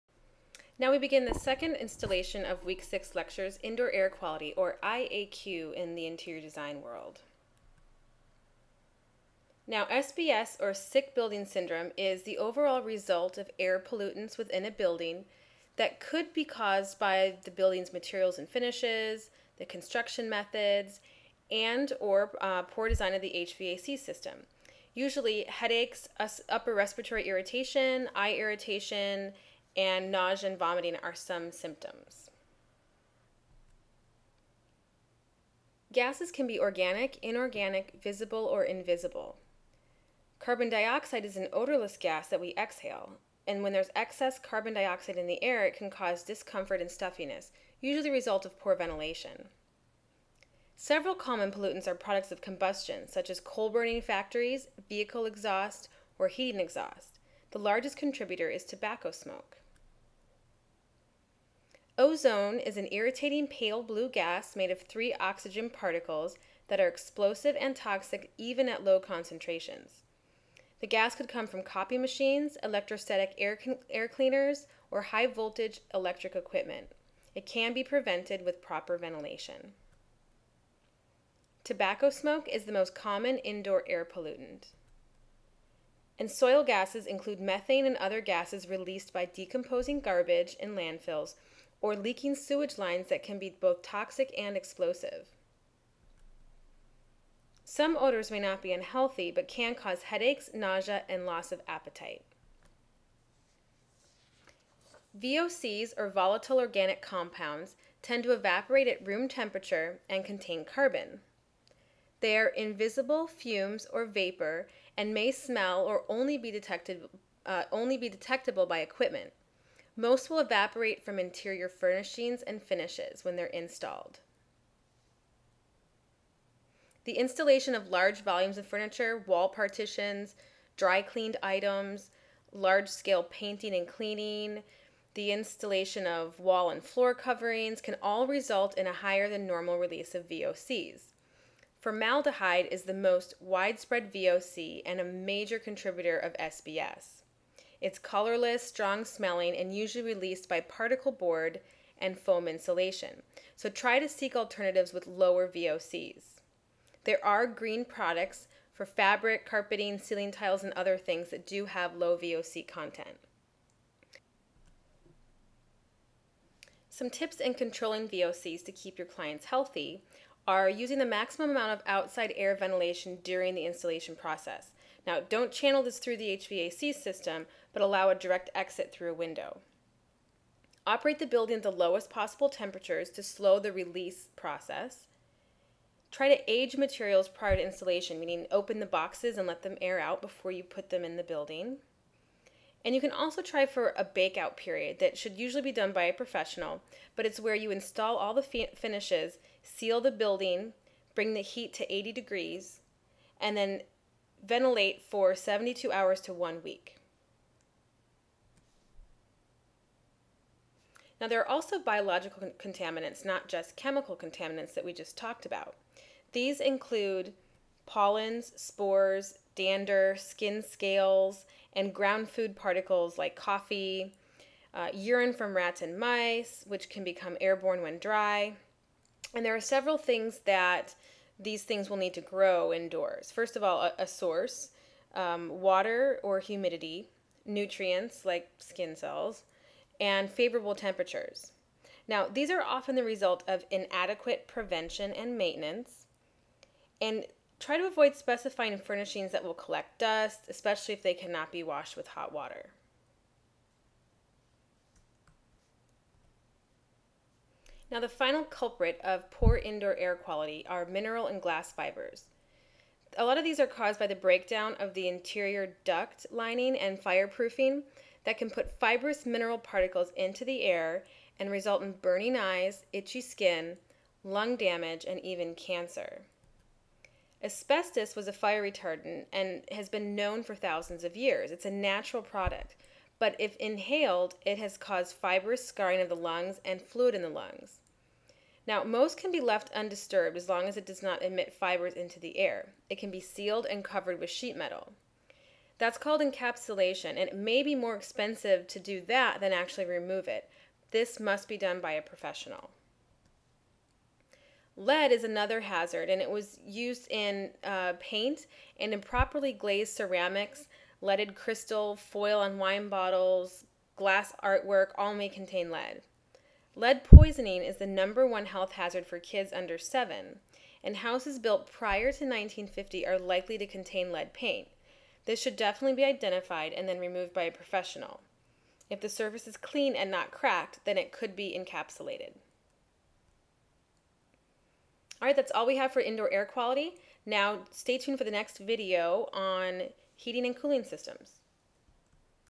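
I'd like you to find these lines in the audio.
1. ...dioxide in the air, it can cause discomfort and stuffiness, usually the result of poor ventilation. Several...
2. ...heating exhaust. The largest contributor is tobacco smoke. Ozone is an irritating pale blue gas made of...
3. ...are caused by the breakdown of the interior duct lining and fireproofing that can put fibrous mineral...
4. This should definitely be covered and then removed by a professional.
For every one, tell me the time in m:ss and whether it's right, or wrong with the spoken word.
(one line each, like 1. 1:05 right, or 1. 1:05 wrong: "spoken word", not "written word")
1. 0:44 right
2. 0:56 right
3. 4:23 right
4. 5:25 wrong: "identified", not "covered".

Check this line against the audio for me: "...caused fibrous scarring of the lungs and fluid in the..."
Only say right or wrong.
right.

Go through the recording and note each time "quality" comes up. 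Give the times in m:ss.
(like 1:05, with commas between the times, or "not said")
0:04, 4:20, 5:36.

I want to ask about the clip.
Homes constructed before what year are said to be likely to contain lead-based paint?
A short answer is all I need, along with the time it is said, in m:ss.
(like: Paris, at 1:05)
1950, at 5:22.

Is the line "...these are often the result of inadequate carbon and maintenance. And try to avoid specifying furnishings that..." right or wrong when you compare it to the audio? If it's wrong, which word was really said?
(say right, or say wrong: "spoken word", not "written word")
wrong: "prevention", not "carbon".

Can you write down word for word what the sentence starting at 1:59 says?
Most will evaporate from interior furnishings and finishes when they're installed.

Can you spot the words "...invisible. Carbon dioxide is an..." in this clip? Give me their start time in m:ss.
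0:38.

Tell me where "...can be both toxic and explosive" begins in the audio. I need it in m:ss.
1:33.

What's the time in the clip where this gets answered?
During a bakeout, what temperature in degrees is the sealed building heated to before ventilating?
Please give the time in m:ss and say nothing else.
3:21.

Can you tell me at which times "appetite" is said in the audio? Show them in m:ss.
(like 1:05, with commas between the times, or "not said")
1:41.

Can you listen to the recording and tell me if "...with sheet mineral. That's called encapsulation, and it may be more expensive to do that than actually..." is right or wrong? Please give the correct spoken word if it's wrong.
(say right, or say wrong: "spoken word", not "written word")
wrong: "metal", not "mineral".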